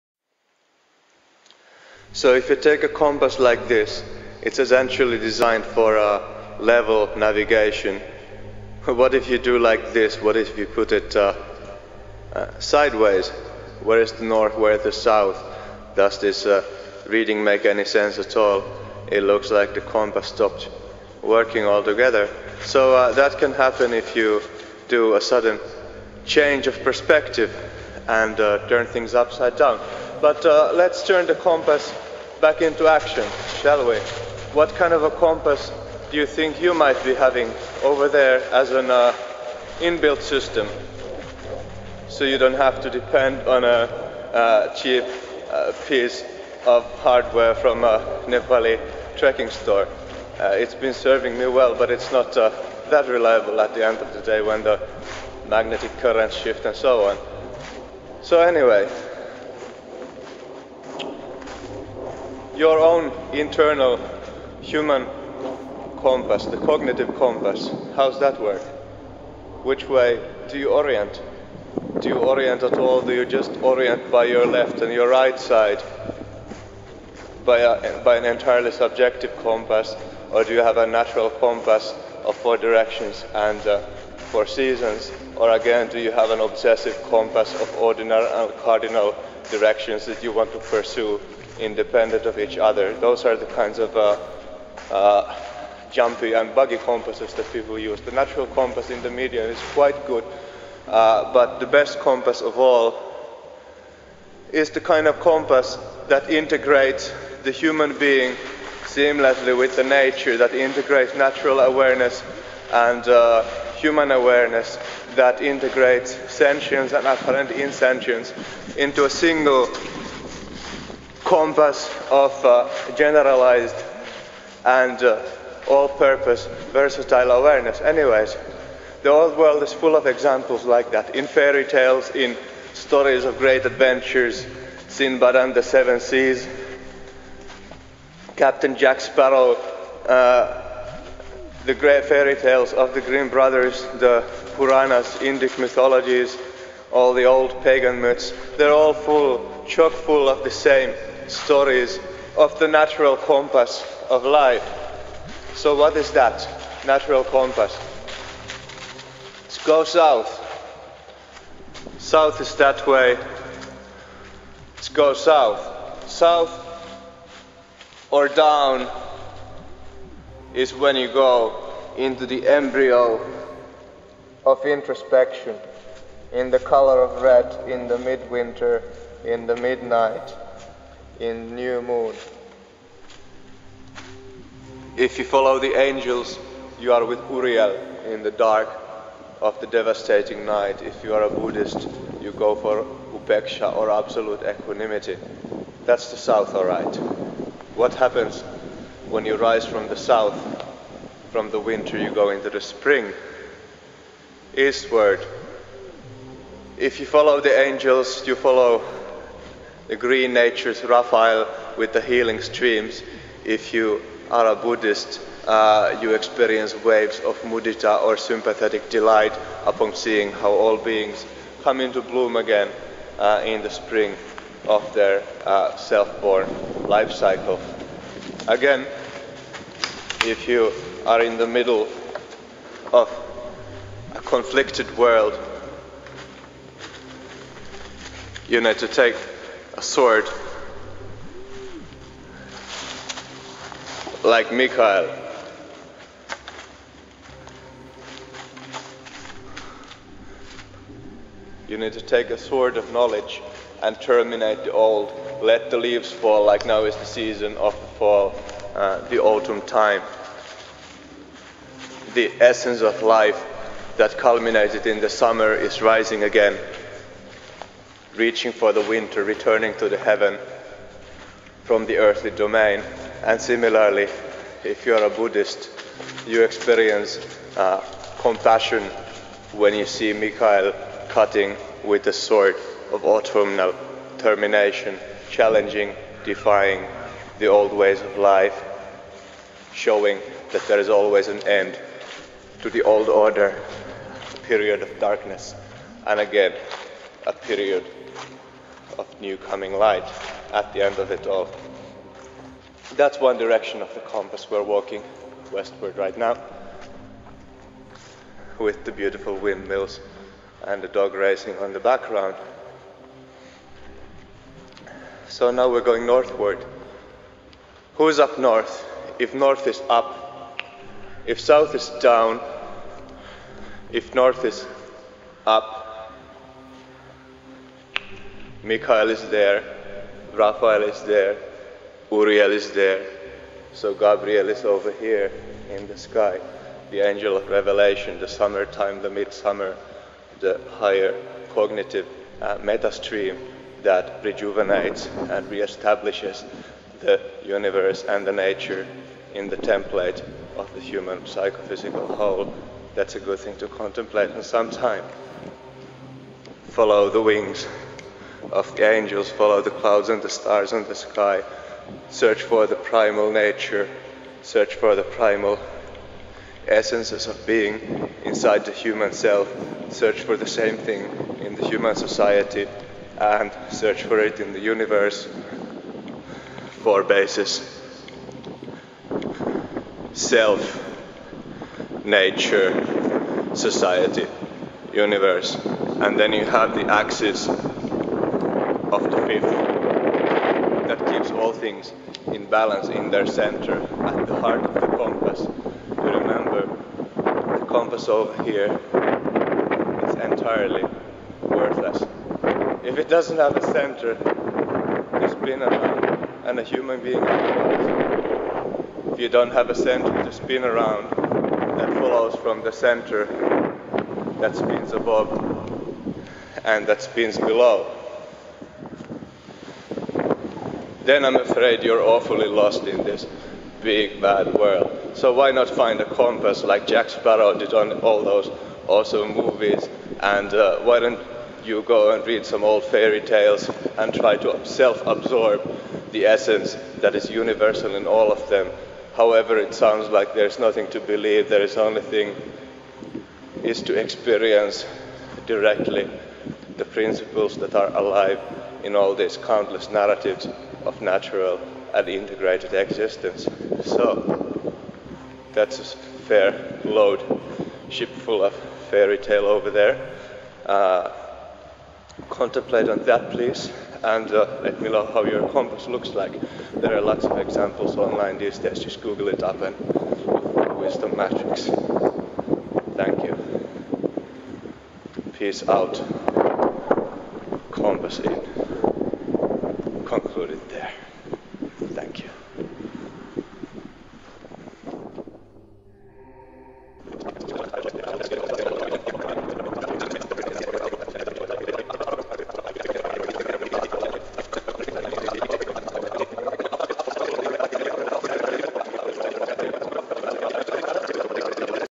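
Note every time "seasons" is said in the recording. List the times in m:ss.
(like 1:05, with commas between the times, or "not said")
1:24, 4:17.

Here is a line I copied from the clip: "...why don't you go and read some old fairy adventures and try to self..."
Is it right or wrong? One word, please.
wrong.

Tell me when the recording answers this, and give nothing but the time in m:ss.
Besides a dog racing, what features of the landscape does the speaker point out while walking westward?
5:09.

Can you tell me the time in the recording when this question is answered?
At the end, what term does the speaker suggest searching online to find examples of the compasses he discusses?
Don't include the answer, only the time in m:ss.
7:50.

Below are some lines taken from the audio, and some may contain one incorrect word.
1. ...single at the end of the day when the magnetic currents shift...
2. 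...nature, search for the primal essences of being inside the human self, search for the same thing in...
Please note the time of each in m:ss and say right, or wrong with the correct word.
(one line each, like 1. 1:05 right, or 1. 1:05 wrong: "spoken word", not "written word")
1. 0:53 wrong: "reliable", not "single"
2. 6:03 right.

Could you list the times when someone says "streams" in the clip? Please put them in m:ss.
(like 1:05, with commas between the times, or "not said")
3:32, 5:42.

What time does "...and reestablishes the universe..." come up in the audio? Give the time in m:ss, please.
5:45.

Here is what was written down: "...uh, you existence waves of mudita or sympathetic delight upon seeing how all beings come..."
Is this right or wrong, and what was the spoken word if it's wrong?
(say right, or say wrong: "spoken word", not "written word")
wrong: "experience", not "existence".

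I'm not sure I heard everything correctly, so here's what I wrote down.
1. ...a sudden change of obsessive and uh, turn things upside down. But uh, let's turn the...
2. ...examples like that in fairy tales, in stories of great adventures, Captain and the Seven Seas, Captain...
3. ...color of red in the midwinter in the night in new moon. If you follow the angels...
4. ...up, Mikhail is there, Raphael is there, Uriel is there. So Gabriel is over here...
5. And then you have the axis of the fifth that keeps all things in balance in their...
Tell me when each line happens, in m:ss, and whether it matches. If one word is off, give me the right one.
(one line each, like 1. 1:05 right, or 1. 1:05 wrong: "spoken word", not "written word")
1. 0:25 wrong: "perspective", not "obsessive"
2. 2:10 wrong: "Sinbad", not "Captain"
3. 2:56 wrong: "midnight", not "night"
4. 5:25 right
5. 6:25 right.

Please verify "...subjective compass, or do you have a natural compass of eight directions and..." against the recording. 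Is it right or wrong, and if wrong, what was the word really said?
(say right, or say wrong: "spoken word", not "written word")
wrong: "four", not "eight".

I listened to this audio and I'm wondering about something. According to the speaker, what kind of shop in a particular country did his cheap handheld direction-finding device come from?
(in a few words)
Nepali trekking store.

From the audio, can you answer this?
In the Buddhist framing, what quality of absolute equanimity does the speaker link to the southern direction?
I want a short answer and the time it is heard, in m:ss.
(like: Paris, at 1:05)
Upeksha, at 3:13.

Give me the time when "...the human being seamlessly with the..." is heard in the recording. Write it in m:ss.
1:47.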